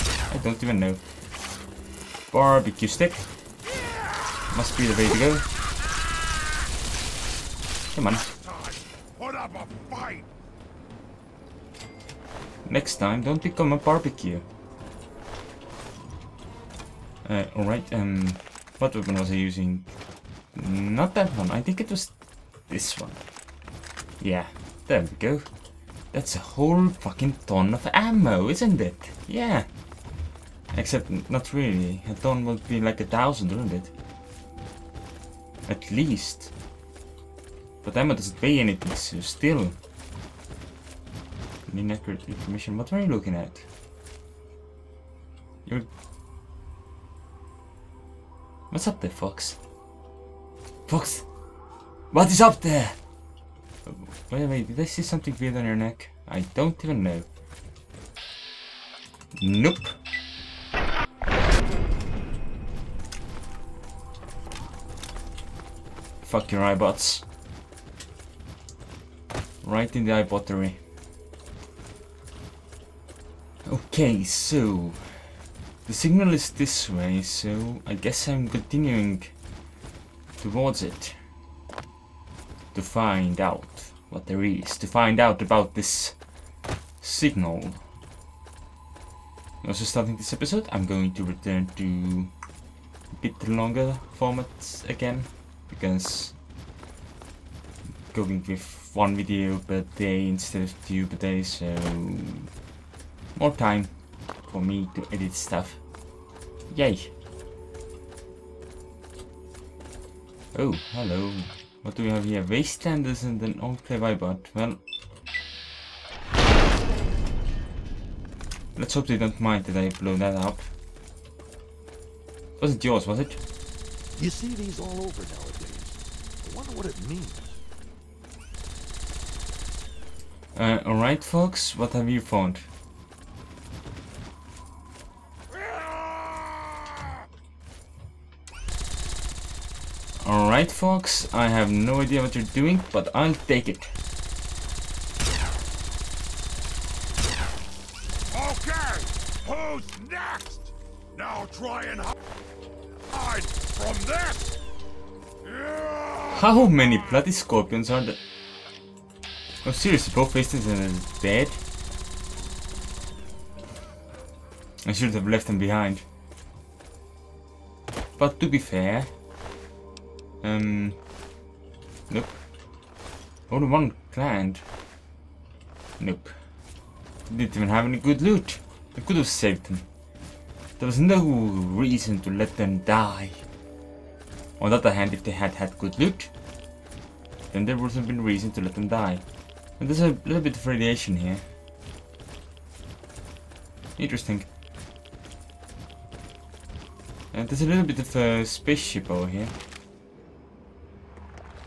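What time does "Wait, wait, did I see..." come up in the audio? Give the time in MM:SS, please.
00:54.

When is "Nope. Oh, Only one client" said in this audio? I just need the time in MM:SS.
02:52.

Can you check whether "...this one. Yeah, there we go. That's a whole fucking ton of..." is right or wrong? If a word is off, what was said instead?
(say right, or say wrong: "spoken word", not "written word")
right.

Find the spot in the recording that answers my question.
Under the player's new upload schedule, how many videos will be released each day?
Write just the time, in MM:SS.
01:38.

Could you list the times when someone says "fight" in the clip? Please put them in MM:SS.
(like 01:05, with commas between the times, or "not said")
00:09.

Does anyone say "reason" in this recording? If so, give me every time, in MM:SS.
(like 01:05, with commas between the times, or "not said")
03:01, 03:08.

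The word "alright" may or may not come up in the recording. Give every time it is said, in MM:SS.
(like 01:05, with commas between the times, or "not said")
00:17, 02:10.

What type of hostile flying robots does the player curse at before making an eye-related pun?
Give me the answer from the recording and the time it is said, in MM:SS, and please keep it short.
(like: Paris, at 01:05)
eyebots, at 01:06.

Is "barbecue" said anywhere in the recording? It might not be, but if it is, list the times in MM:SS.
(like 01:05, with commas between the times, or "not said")
00:02, 00:13.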